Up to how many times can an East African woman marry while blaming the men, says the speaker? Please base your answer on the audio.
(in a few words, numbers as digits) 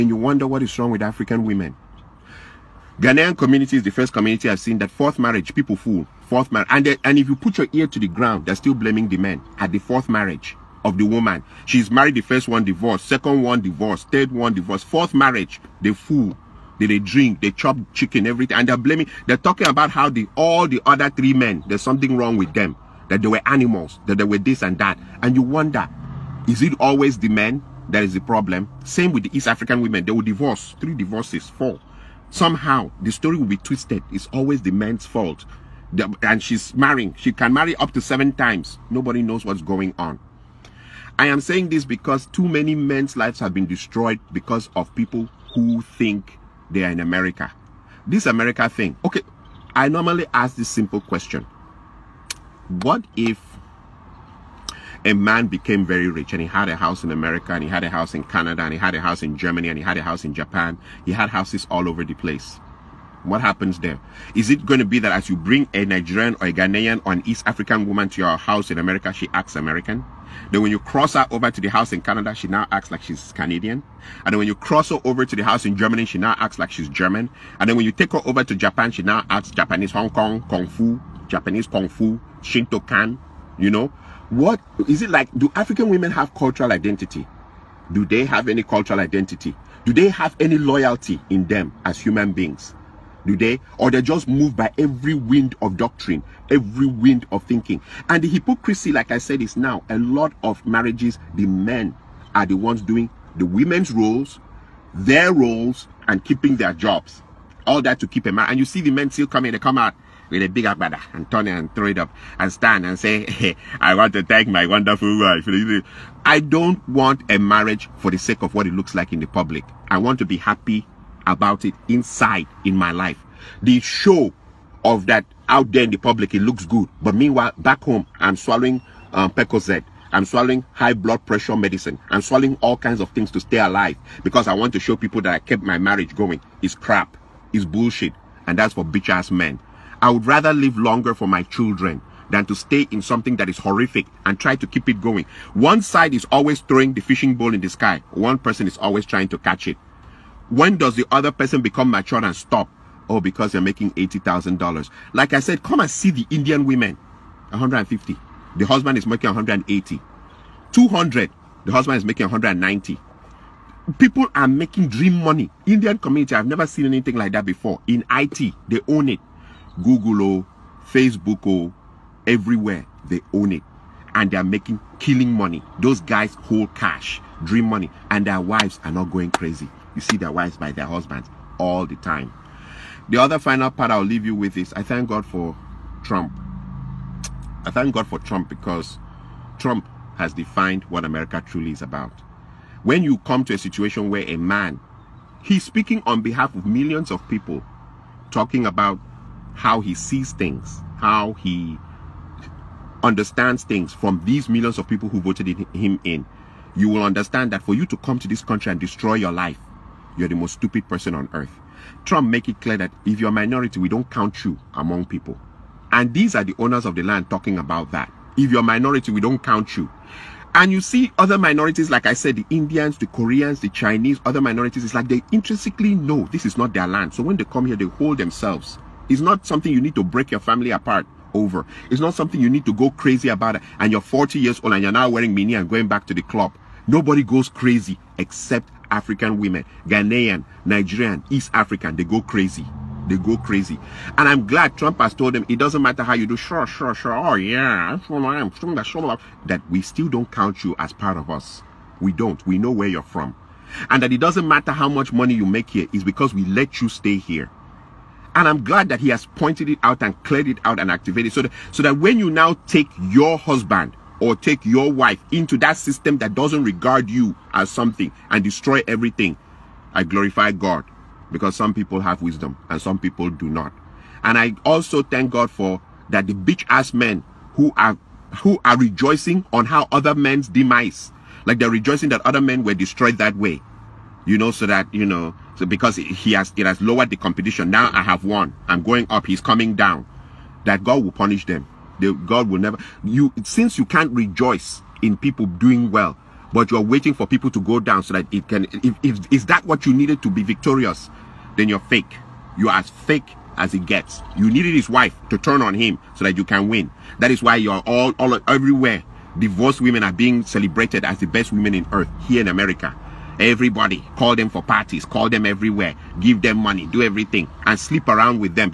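7.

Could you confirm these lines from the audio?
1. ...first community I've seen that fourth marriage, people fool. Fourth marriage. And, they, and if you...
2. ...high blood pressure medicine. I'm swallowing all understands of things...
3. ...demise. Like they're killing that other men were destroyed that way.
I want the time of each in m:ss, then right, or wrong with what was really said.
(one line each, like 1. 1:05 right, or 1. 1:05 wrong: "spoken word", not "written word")
1. 0:03 right
2. 2:10 wrong: "kinds", not "understands"
3. 4:40 wrong: "rejoicing", not "killing".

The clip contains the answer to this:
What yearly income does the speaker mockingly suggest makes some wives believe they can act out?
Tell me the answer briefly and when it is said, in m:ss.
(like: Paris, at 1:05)
$80,000, at 2:33.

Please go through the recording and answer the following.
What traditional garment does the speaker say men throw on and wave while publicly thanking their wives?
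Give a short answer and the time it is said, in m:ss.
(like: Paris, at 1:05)
agbada, at 1:50.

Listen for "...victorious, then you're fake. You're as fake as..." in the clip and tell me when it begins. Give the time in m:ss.
5:00.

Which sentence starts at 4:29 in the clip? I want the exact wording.
I glorify God because some people have wisdom and some people do not.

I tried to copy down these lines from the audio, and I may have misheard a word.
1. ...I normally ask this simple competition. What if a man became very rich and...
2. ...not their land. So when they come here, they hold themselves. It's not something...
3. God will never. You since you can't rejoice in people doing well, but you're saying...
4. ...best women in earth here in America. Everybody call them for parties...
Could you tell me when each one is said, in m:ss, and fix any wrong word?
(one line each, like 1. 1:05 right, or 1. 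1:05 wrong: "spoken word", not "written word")
1. 0:49 wrong: "question", not "competition"
2. 3:46 right
3. 4:52 wrong: "waiting", not "saying"
4. 5:11 right.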